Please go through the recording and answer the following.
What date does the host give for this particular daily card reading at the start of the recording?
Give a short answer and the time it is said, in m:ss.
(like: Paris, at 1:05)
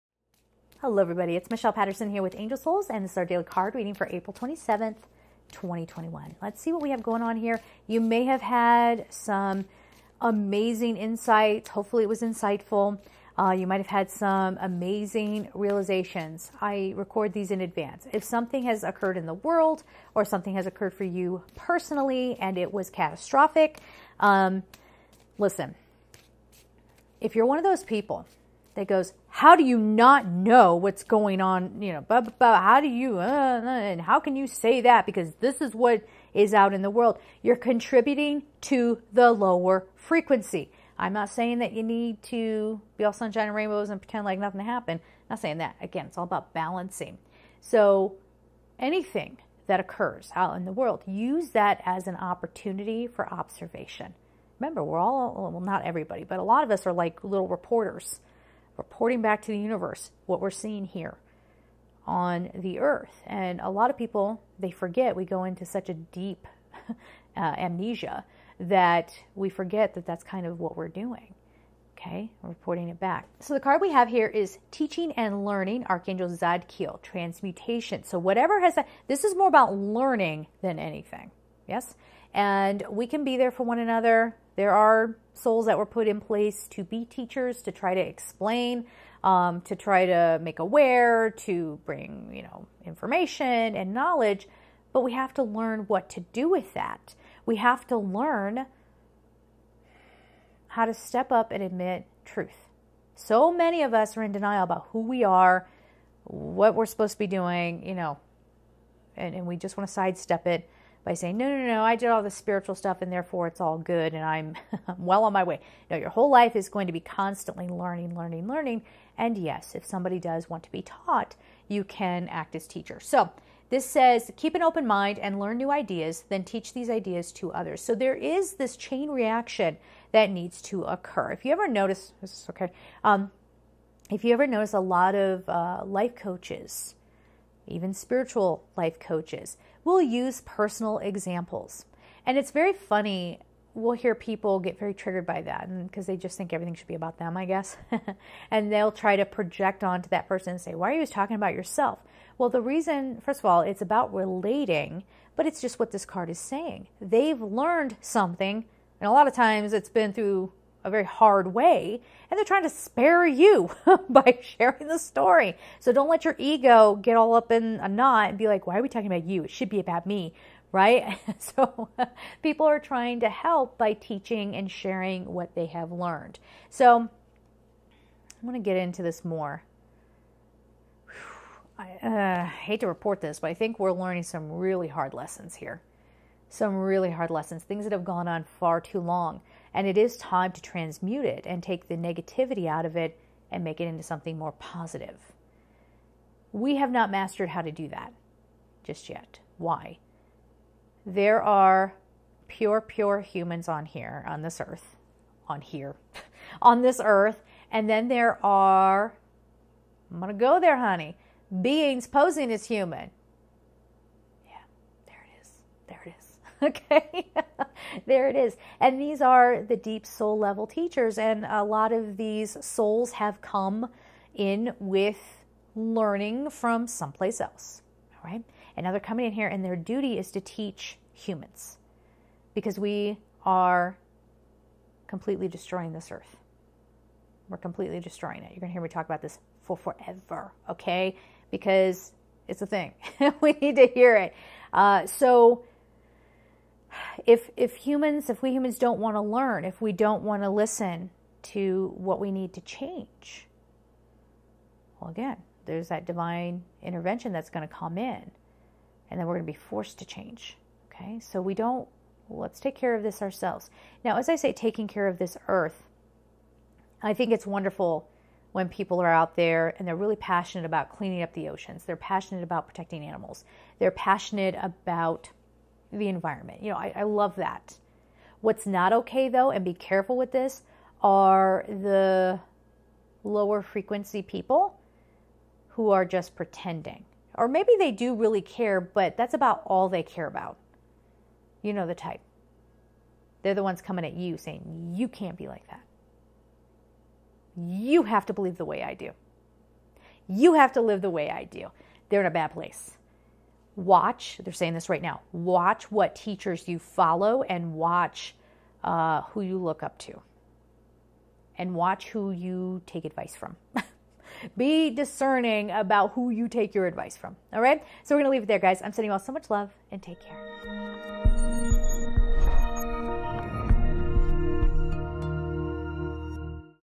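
April 27th, 2021, at 0:04.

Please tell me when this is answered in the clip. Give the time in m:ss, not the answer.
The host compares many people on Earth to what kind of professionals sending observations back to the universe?
0:57.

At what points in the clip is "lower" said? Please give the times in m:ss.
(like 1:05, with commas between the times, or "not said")
0:39, 4:43.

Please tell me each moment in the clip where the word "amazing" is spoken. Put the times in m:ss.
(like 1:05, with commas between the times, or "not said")
0:10, 0:14.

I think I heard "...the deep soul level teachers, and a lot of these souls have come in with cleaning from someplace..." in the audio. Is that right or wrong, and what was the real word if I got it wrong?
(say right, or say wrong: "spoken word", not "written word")
wrong: "learning", not "cleaning".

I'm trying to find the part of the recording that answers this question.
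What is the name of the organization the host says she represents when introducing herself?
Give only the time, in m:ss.
0:02.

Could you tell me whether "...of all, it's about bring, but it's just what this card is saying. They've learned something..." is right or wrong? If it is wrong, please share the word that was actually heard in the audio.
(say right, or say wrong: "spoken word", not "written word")
wrong: "relating", not "bring".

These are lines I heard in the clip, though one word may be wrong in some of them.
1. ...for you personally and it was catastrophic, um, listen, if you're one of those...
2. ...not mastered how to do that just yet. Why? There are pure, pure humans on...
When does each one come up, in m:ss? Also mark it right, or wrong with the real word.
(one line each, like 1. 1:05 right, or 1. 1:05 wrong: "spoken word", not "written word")
1. 0:20 right
2. 3:16 right.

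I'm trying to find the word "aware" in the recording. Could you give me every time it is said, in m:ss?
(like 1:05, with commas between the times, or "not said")
1:30.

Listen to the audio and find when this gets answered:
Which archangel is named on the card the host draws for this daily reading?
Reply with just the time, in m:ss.
1:16.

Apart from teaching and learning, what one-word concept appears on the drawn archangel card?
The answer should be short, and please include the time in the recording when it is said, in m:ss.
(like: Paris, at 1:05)
Transmutation, at 1:17.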